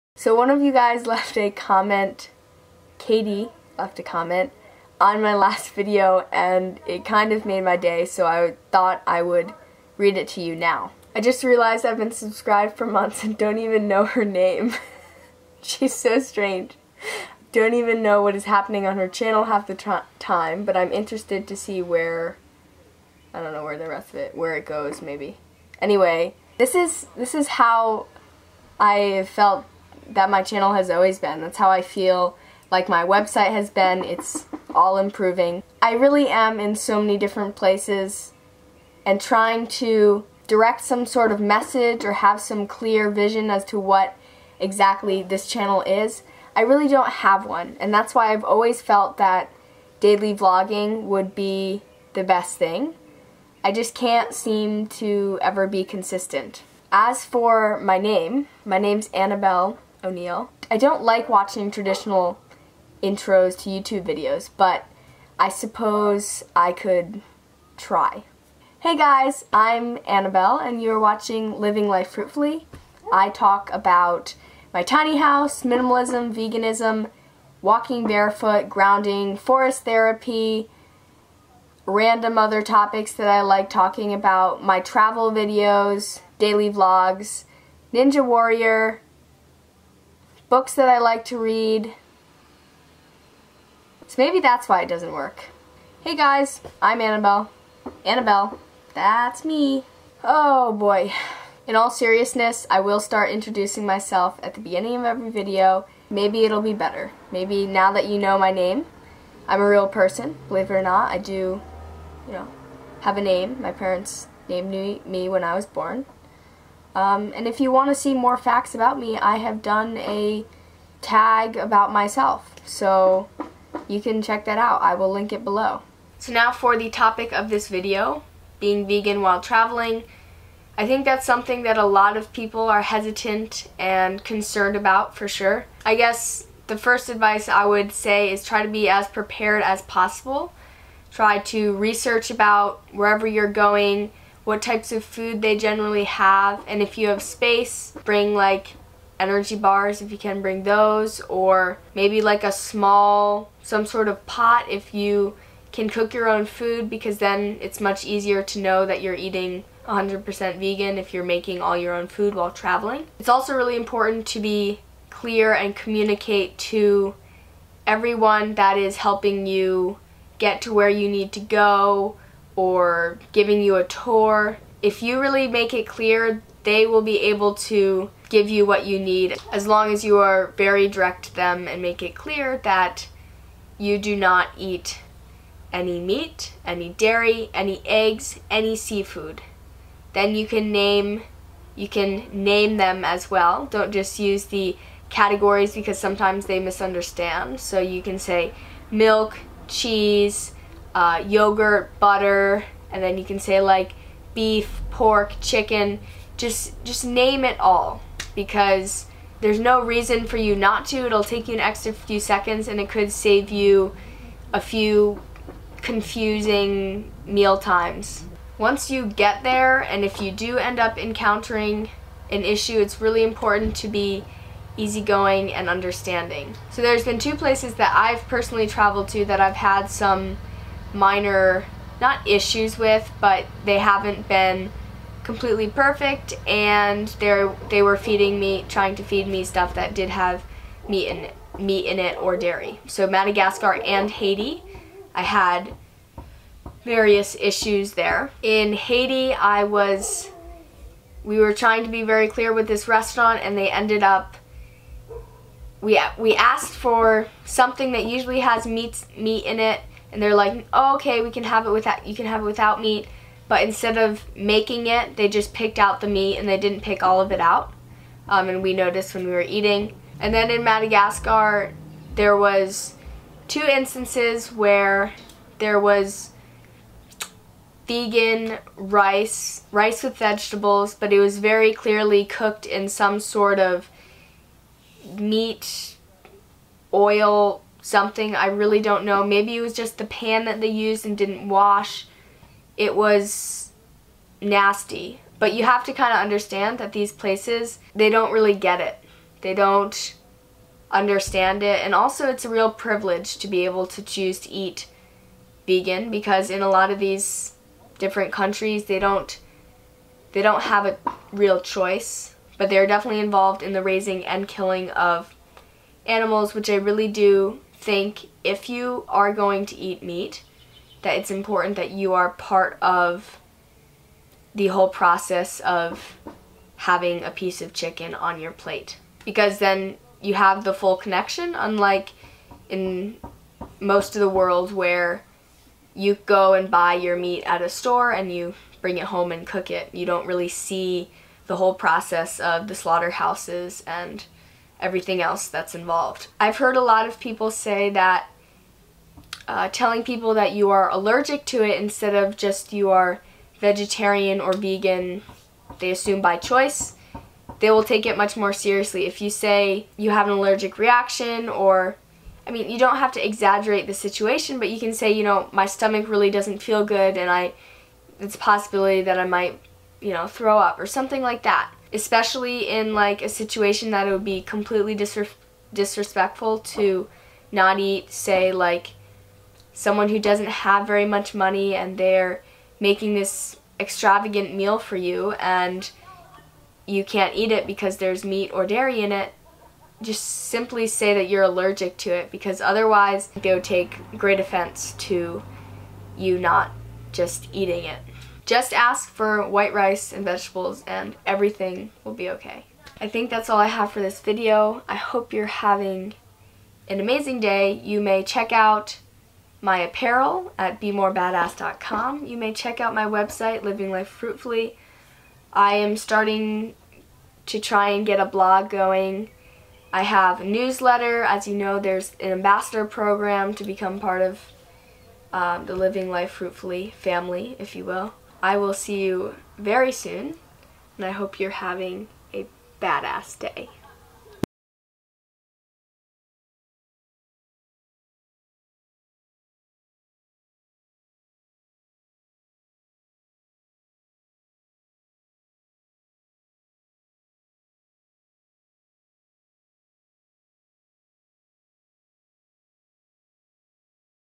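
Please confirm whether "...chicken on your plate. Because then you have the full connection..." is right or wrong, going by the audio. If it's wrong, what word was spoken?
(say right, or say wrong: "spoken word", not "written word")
right.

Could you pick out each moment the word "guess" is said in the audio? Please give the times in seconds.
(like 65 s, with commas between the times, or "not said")
135 s.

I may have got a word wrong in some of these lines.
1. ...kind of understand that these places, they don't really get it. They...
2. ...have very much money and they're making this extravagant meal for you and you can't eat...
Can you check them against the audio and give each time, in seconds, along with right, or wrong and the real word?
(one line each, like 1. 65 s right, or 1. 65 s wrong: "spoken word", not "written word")
1. 295 s right
2. 380 s right.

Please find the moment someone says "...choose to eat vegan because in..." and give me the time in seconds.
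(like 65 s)
304 s.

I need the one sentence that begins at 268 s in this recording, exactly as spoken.
Um, and we noticed when we were eating.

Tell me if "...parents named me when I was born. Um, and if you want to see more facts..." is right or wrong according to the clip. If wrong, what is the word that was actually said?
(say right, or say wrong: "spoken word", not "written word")
right.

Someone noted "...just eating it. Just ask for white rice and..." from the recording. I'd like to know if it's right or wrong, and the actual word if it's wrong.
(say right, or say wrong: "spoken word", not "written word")
right.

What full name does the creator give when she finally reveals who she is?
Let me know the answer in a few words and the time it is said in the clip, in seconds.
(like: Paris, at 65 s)
Annabel O'Neill, at 59 s.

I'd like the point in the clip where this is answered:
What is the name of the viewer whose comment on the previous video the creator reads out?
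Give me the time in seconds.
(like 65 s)
2 s.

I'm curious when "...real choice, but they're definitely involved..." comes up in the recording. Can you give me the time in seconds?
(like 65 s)
311 s.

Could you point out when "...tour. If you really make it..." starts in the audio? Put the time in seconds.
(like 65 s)
173 s.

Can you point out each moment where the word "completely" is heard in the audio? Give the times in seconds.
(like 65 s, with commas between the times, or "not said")
235 s, 374 s.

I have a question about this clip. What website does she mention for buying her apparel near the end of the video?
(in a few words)
bemorebadass.com.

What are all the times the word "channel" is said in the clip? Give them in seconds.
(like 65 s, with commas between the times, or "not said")
19 s, 30 s, 45 s.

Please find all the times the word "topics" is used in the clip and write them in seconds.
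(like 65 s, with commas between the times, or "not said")
82 s, 126 s.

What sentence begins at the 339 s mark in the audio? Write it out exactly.
You don't really see the whole process of the slaughterhouses and everything else that's involved.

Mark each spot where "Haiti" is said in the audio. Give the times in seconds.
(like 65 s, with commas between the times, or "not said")
244 s, 248 s.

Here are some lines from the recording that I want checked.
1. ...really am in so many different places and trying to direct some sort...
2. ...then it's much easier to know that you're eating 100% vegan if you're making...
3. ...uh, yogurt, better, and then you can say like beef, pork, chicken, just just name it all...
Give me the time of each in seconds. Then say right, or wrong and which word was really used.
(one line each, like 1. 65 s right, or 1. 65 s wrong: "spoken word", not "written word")
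1. 35 s right
2. 157 s right
3. 200 s wrong: "butter", not "better".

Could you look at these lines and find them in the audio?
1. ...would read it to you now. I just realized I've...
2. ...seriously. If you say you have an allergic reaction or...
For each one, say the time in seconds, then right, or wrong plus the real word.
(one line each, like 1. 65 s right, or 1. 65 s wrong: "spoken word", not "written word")
1. 9 s right
2. 358 s right.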